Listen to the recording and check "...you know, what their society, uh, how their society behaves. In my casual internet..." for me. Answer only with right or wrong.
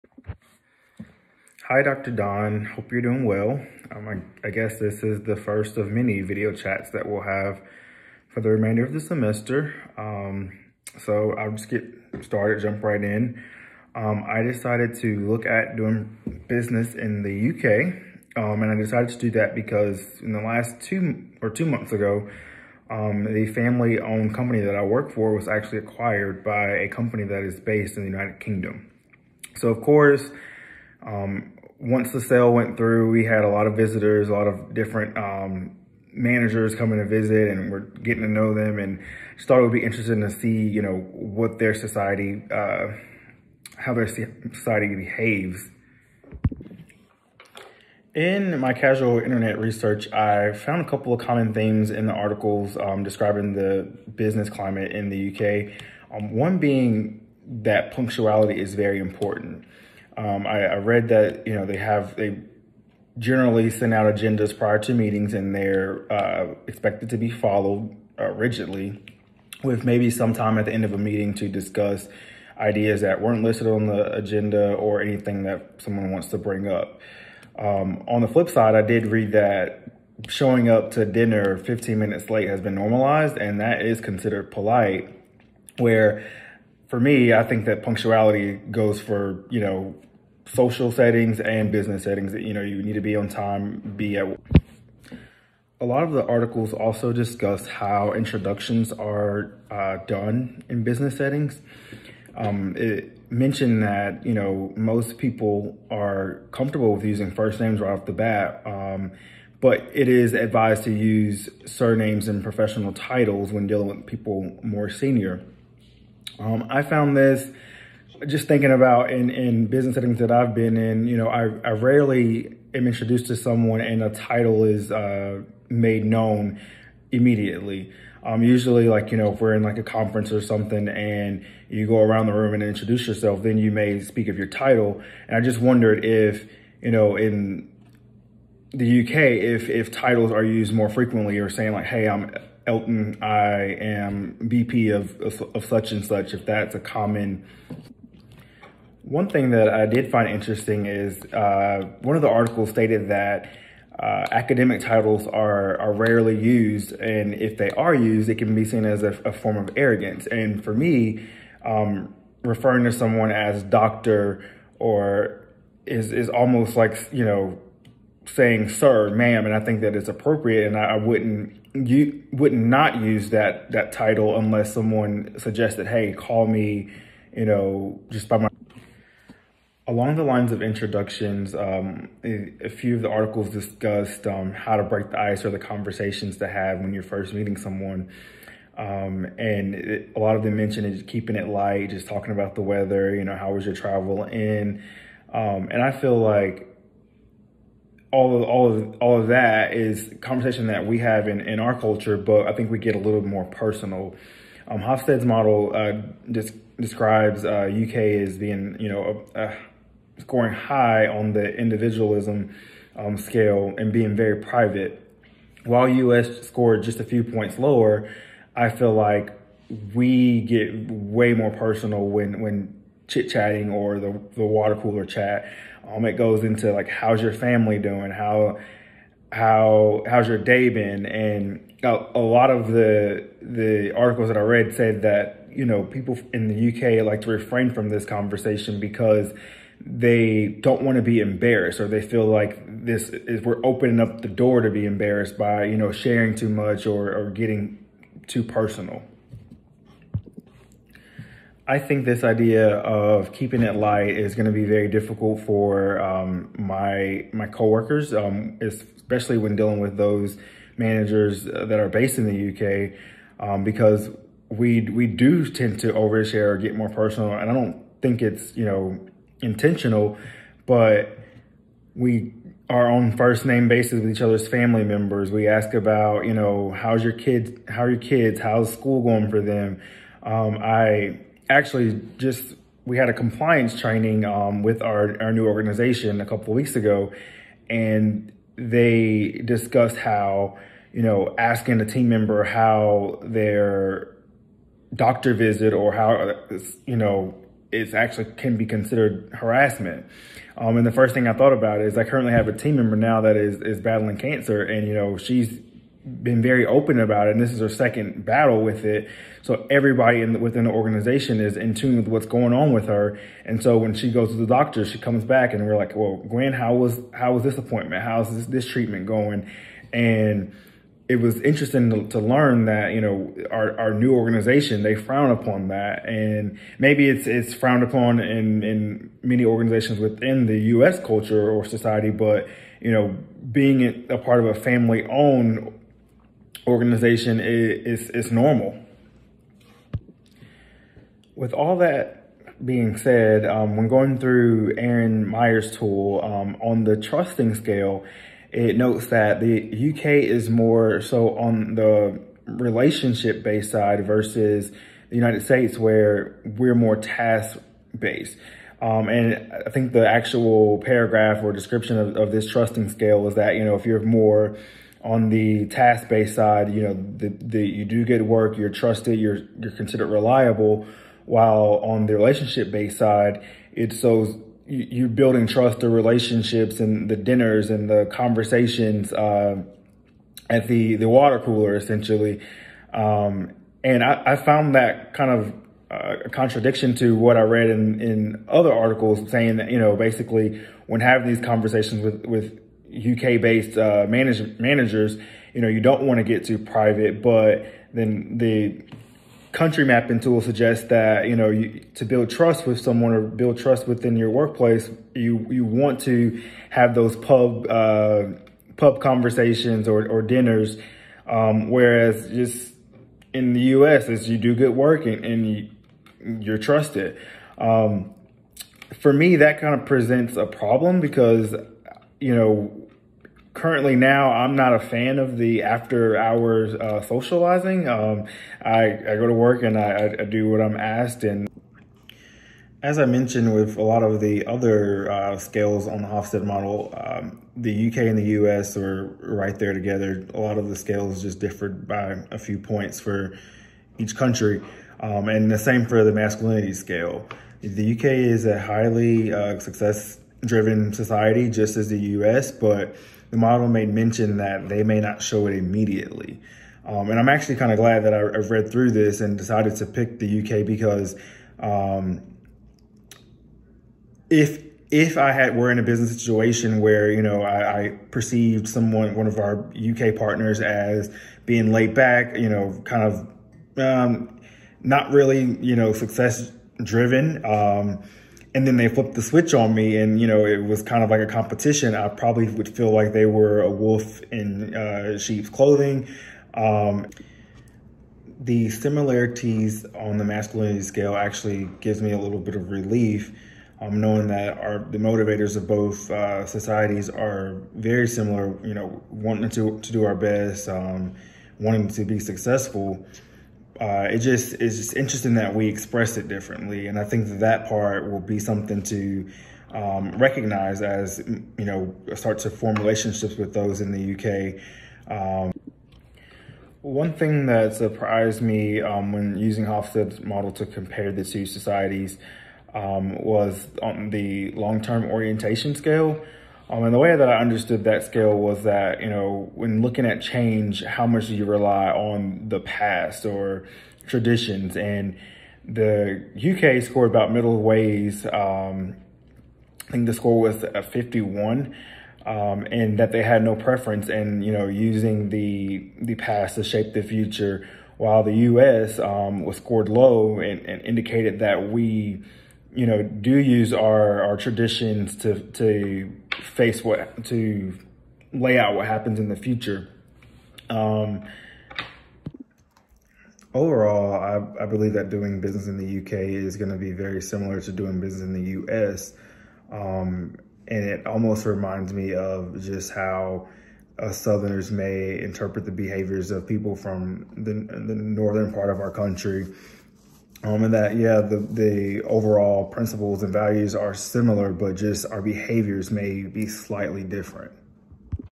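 right.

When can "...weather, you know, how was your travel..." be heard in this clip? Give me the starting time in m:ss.
3:12.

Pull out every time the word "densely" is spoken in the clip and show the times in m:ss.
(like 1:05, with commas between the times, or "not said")
not said.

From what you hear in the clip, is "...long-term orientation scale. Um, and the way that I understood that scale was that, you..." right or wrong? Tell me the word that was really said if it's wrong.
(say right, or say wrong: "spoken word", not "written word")
right.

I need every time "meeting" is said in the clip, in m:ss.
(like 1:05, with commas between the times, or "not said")
1:04, 1:10, 3:07.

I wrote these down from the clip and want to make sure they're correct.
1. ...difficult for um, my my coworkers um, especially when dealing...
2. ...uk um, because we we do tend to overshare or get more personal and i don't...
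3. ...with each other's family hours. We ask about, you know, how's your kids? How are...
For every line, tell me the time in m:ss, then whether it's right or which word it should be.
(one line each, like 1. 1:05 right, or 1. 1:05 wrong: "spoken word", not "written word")
1. 4:14 right
2. 4:23 right
3. 4:34 wrong: "members", not "hours".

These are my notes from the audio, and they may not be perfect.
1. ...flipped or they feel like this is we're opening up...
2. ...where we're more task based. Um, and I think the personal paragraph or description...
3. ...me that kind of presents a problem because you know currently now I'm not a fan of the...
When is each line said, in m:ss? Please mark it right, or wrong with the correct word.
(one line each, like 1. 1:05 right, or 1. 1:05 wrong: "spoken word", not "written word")
1. 4:01 wrong: "embarrassed", not "flipped"
2. 5:55 wrong: "actual", not "personal"
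3. 6:59 right.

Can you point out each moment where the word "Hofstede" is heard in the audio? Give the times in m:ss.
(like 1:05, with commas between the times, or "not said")
3:24, 7:16, 8:39.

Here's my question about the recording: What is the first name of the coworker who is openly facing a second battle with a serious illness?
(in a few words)
Gwen.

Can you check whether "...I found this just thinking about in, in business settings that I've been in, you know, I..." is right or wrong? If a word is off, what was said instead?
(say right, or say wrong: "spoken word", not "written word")
right.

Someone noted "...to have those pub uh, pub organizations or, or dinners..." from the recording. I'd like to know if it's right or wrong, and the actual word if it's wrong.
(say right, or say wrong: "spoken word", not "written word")
wrong: "conversations", not "organizations".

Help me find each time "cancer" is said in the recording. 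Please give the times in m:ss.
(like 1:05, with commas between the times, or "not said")
5:04.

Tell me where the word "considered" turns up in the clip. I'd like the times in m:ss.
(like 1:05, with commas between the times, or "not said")
1:24, 4:58, 6:09.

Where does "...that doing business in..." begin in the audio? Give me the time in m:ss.
9:24.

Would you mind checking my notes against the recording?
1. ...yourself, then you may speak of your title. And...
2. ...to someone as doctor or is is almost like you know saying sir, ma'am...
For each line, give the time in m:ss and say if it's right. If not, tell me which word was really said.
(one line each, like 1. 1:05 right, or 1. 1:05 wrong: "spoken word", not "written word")
1. 2:13 right
2. 2:42 right.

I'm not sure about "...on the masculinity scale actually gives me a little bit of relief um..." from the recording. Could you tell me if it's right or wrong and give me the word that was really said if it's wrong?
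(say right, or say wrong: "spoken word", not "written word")
right.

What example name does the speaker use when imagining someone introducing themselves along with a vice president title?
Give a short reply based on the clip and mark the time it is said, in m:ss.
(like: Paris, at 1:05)
Elton, at 2:22.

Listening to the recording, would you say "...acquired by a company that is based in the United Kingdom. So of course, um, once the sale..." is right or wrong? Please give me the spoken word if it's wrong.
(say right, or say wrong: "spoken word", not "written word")
right.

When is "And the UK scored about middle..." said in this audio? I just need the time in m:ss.
8:54.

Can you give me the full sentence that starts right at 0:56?
Um, one being that punctuality is very important.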